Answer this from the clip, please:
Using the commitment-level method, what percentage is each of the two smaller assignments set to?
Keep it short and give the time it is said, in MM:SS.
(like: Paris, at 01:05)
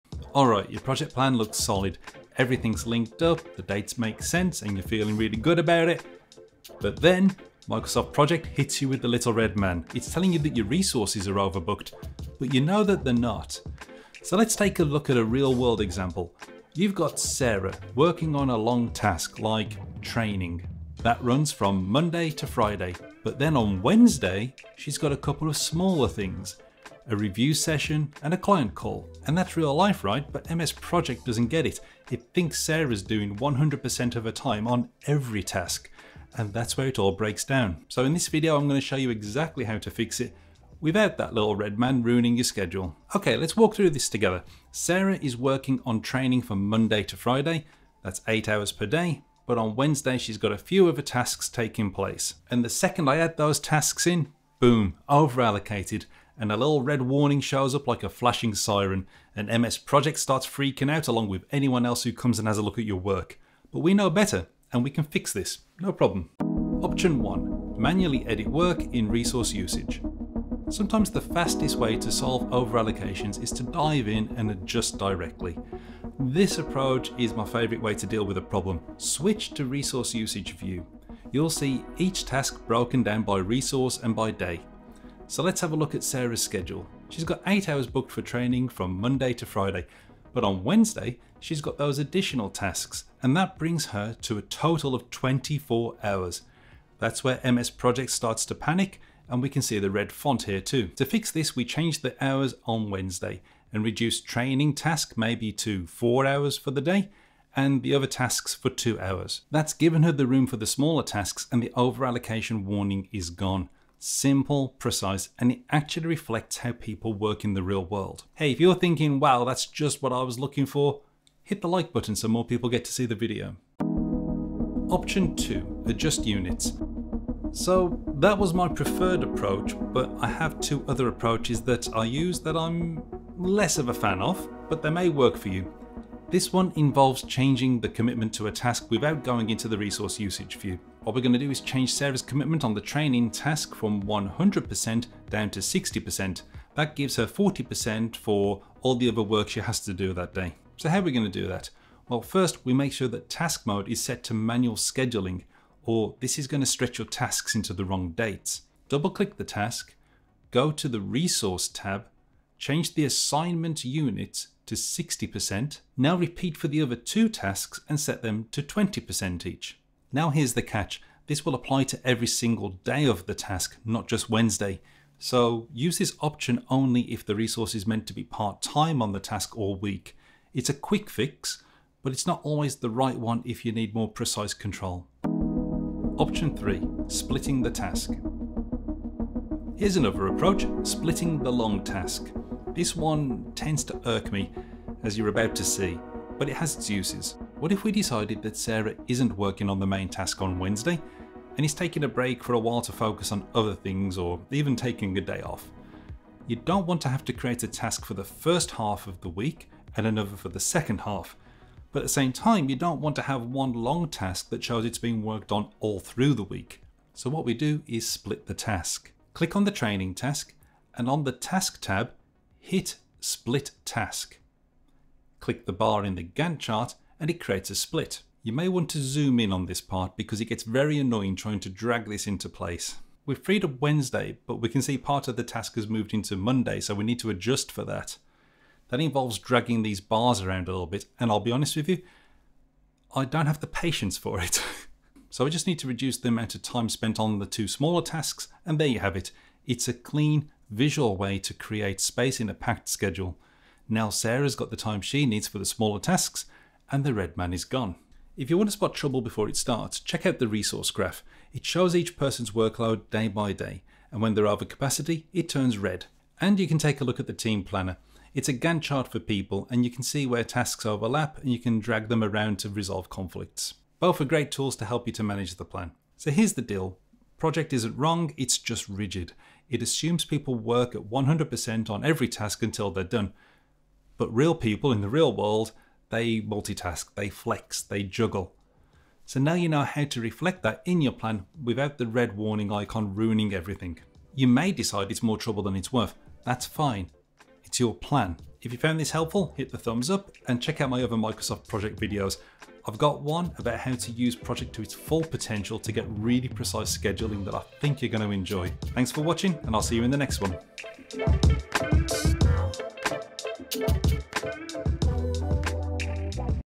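20%, at 02:48.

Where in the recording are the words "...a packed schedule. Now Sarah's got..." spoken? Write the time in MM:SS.
04:12.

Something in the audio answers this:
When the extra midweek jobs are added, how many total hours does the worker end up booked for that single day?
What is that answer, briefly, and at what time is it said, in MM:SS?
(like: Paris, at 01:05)
24, at 01:35.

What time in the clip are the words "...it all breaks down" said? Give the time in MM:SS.
00:36.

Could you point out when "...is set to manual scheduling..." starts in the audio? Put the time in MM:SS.
02:33.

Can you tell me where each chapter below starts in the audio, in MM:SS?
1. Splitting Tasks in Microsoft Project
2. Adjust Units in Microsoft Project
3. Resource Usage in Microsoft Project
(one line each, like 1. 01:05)
1. 03:06
2. 02:04
3. 01:07.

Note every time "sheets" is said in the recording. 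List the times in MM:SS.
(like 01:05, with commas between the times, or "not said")
not said.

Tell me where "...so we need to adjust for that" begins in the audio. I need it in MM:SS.
03:56.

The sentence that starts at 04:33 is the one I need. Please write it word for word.
Both are great tools to help you to manage the plan.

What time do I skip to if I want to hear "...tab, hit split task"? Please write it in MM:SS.
03:41.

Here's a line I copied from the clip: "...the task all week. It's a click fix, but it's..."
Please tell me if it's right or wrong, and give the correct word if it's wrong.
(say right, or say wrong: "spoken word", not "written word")
wrong: "quick", not "click".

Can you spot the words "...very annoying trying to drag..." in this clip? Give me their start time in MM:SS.
03:50.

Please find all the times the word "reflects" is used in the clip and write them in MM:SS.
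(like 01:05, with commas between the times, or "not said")
01:56, 04:50.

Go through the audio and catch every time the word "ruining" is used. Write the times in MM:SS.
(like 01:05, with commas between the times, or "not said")
00:42, 04:53.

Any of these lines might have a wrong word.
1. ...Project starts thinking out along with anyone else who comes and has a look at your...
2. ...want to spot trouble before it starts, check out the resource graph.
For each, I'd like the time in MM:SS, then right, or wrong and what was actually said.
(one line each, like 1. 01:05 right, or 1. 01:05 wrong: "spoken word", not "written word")
1. 00:59 wrong: "freaking", not "thinking"
2. 04:18 right.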